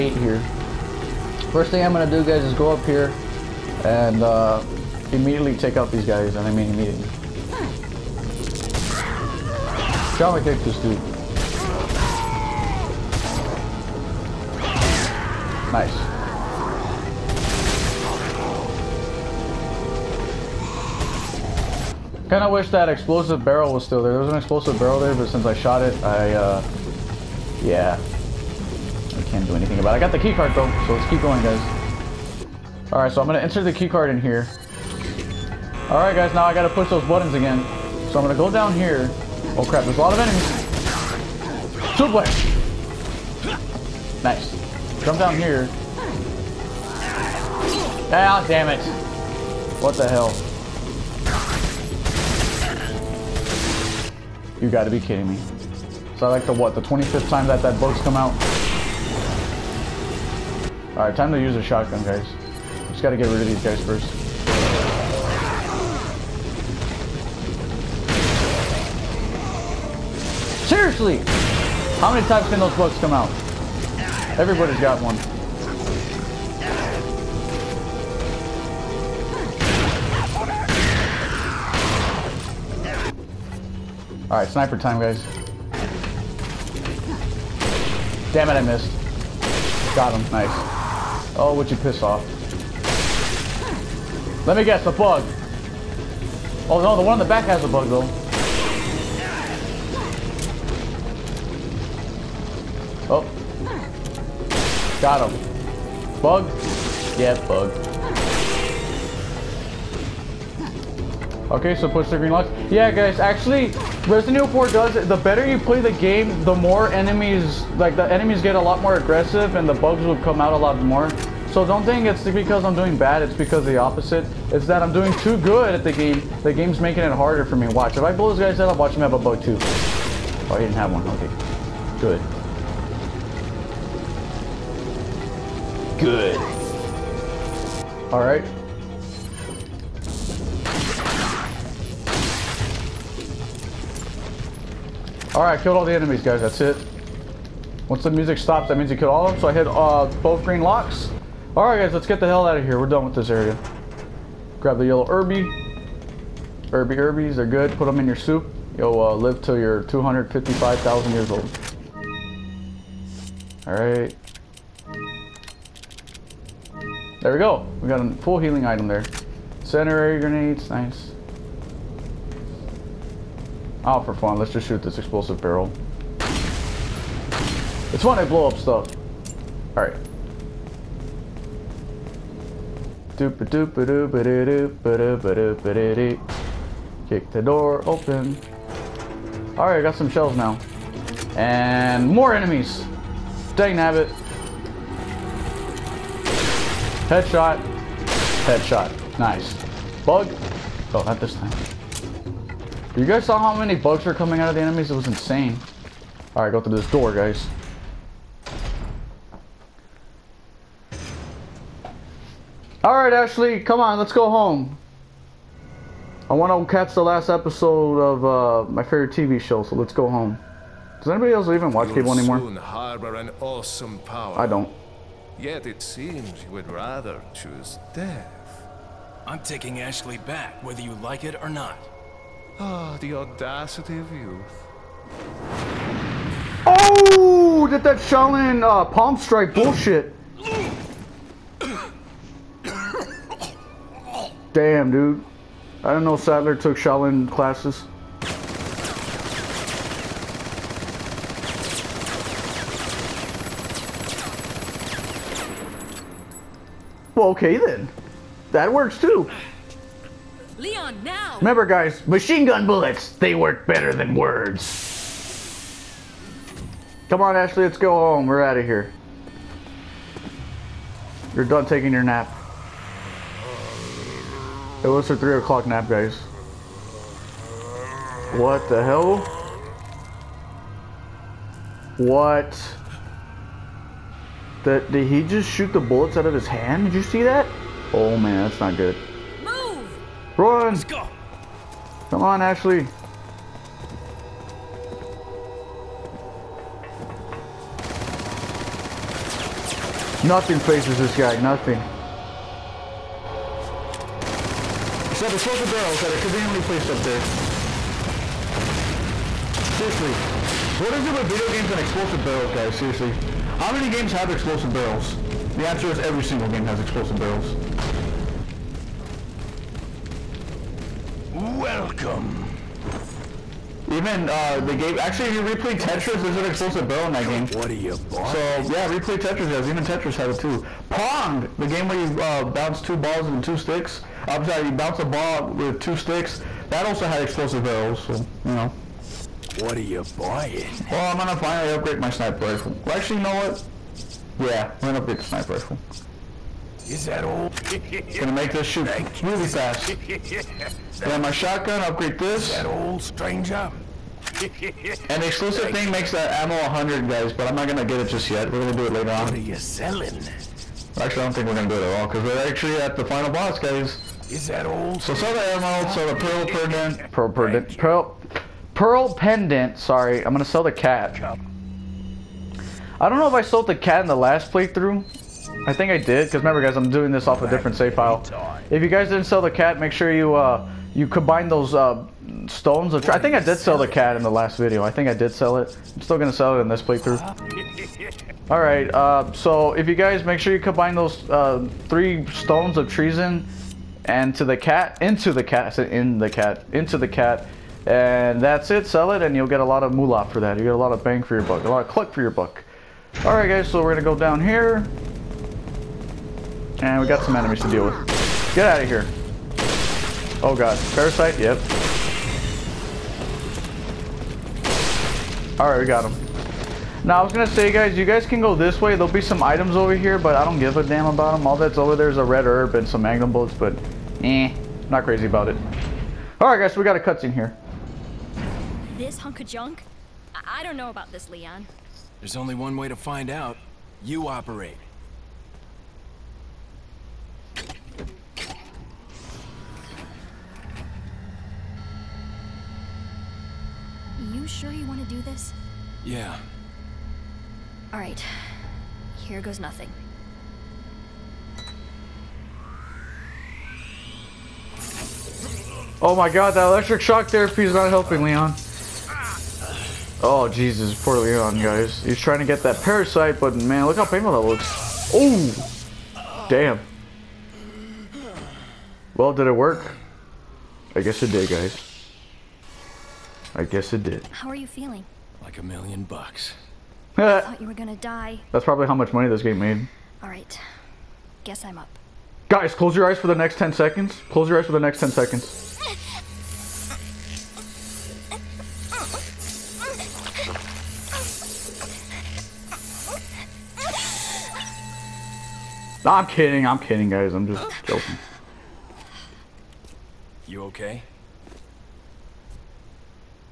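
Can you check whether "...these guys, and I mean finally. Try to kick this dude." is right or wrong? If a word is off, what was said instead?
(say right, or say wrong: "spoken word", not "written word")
wrong: "immediately", not "finally".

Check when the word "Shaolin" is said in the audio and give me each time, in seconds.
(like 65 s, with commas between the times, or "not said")
237 s, 246 s.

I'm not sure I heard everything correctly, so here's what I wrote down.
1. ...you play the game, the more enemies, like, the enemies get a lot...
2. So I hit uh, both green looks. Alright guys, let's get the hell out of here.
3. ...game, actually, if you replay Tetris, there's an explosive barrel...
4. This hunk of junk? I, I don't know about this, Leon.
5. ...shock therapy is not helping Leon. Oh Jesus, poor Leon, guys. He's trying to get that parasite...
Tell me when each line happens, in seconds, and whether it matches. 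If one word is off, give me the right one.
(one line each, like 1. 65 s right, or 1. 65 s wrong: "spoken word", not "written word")
1. 115 s right
2. 149 s wrong: "locks", not "looks"
3. 324 s right
4. 428 s right
5. 457 s right.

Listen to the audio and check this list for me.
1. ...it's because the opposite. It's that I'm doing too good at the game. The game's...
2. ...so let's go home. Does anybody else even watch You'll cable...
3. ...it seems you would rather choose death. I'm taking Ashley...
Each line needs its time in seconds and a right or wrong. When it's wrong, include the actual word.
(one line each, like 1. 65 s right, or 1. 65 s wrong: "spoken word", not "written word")
1. 123 s right
2. 219 s right
3. 225 s right.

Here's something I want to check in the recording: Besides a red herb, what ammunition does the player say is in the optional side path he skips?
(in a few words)
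Magnum bullets.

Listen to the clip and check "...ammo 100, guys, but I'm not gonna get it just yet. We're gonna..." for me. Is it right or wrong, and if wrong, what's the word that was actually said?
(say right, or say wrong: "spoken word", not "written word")
right.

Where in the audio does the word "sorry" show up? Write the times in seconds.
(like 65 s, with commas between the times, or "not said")
334 s, 369 s.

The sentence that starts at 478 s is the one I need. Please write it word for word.
That's probably how much money this game made.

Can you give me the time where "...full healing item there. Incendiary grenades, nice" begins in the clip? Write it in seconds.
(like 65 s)
168 s.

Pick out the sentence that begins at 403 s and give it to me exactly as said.
All right, guys, so we're gonna go down here, and we got some enemies to deal with.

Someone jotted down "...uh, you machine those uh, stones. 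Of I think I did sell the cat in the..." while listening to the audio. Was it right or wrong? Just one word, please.
wrong.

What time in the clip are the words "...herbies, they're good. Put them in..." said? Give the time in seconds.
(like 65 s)
156 s.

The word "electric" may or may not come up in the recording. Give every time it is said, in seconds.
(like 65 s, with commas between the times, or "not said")
456 s.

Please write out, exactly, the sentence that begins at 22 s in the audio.
Kind of wish that explosive barrel was still there.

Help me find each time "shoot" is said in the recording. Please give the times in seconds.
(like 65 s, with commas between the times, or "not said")
174 s, 285 s, 348 s.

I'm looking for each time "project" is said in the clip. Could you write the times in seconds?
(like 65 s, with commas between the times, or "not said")
not said.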